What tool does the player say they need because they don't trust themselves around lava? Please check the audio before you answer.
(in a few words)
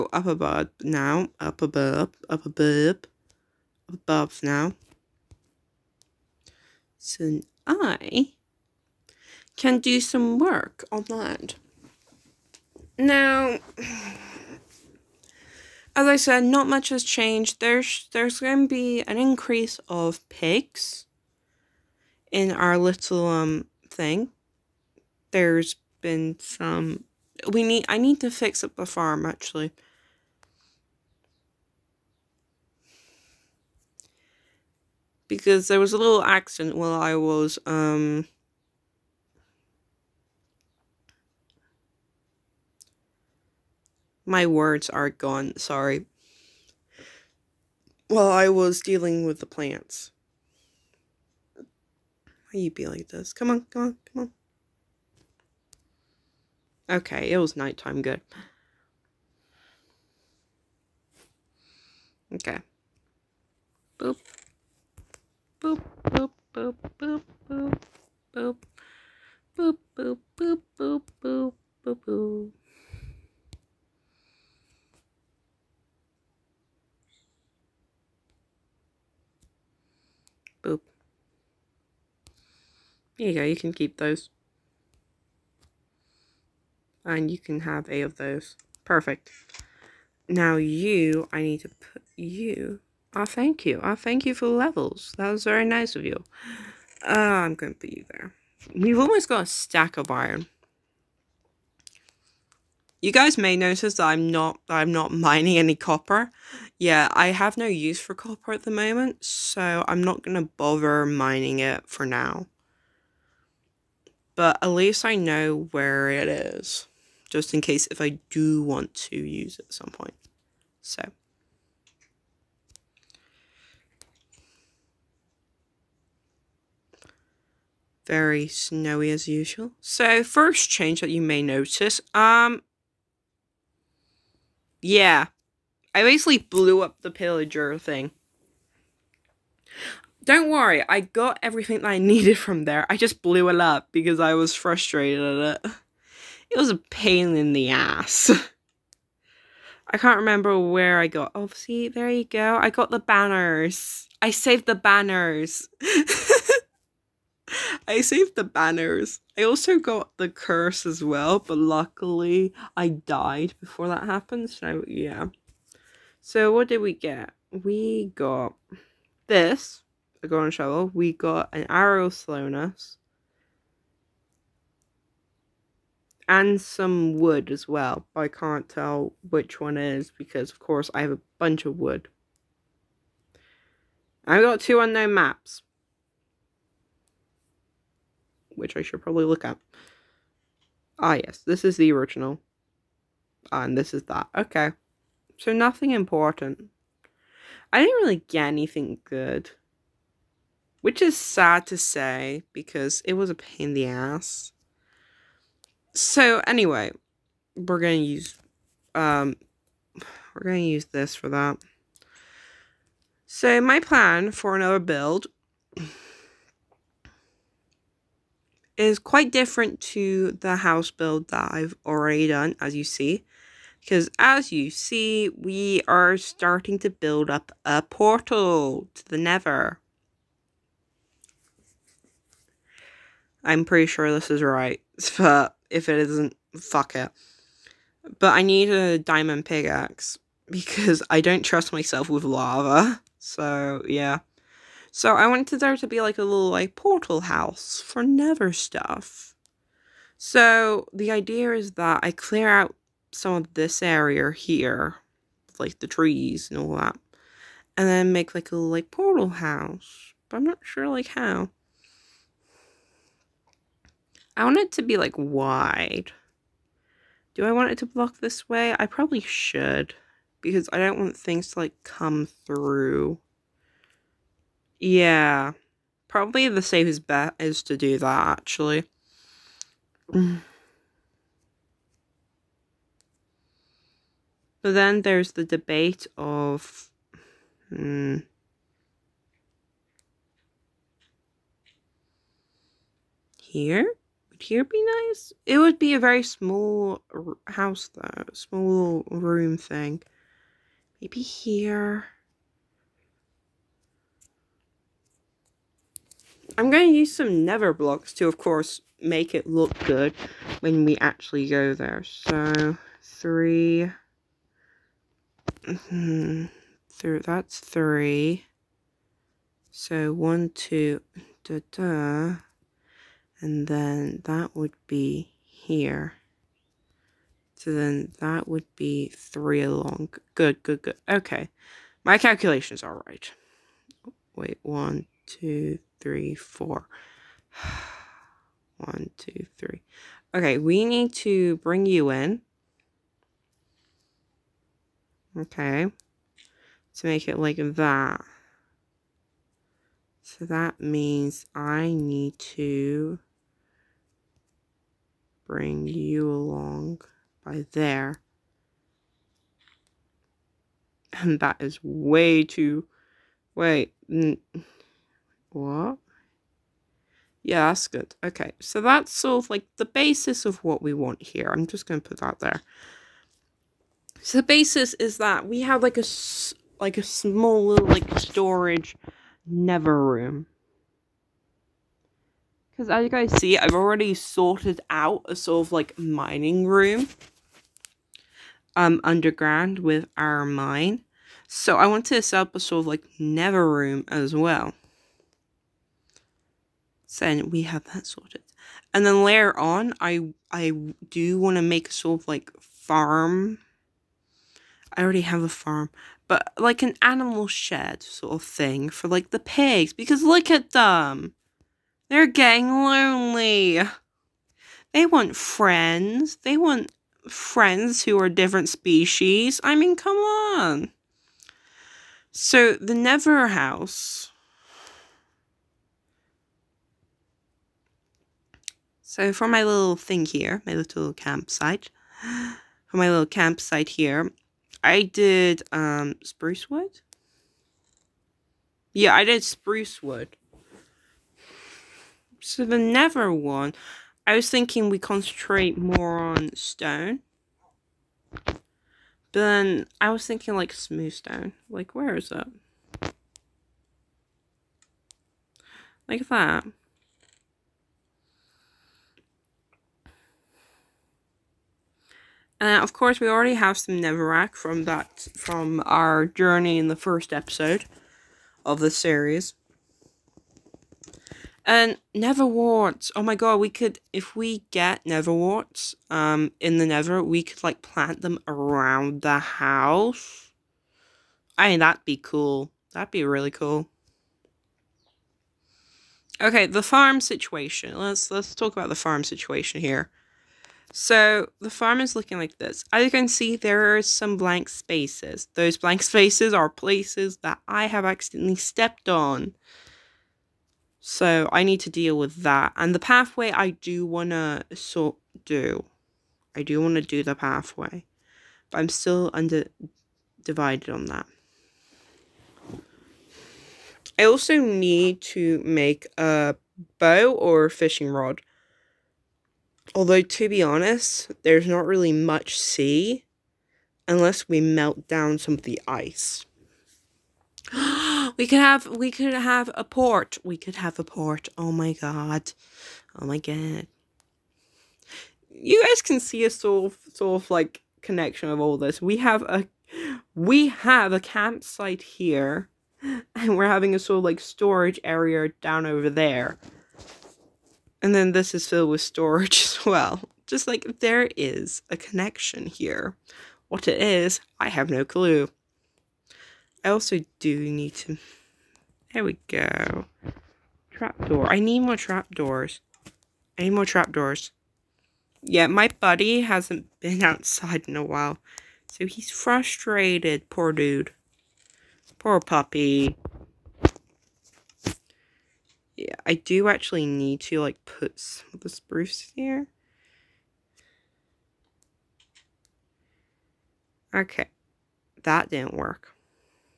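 Diamond pickaxe.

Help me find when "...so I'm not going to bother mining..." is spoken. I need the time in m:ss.
1:49.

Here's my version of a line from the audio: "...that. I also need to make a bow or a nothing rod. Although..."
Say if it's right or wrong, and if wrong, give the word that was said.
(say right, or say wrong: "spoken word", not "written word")
wrong: "fishing", not "nothing".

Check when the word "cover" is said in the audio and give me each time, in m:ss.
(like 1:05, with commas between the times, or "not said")
not said.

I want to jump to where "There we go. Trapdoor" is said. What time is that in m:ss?
9:19.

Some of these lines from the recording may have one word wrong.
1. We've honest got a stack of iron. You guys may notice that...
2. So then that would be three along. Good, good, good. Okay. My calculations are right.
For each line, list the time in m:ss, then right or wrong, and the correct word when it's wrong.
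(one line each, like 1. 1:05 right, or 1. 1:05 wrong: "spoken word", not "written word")
1. 1:38 wrong: "almost", not "honest"
2. 5:27 right.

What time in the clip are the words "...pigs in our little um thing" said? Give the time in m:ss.
0:20.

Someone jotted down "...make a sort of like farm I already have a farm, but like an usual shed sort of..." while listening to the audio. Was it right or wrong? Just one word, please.
wrong.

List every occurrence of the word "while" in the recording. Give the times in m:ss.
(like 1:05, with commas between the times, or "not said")
0:36, 0:48, 9:28.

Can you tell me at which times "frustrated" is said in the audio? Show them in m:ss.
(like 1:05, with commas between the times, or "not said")
2:24, 9:29.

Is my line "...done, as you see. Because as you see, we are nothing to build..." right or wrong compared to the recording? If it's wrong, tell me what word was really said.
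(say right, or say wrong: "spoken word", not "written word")
wrong: "starting", not "nothing".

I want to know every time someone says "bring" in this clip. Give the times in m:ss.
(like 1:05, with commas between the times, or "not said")
5:41, 5:55.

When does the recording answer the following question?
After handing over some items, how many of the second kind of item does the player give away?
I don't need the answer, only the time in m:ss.
1:27.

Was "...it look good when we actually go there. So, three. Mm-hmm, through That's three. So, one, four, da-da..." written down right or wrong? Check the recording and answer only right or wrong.
wrong.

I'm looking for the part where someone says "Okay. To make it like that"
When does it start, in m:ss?
5:45.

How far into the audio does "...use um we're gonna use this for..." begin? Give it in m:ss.
3:28.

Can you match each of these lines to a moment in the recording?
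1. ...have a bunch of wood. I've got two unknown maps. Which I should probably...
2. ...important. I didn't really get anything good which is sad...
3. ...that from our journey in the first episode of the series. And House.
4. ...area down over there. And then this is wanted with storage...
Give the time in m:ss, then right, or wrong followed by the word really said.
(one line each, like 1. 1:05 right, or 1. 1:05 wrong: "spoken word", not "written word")
1. 3:01 right
2. 3:15 right
3. 7:44 wrong: "Netherwarts", not "House"
4. 9:05 wrong: "filled", not "wanted".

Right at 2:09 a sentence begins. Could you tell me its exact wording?
So first change that you may notice, um, yeah, I basically blew up the pillager thing.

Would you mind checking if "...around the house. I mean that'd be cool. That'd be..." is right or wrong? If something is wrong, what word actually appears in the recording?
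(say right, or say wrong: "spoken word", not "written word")
right.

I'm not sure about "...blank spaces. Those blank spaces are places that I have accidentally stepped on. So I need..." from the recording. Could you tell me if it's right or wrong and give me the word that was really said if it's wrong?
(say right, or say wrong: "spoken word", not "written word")
right.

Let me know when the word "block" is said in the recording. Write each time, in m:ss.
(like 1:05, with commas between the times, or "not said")
4:27, 5:07.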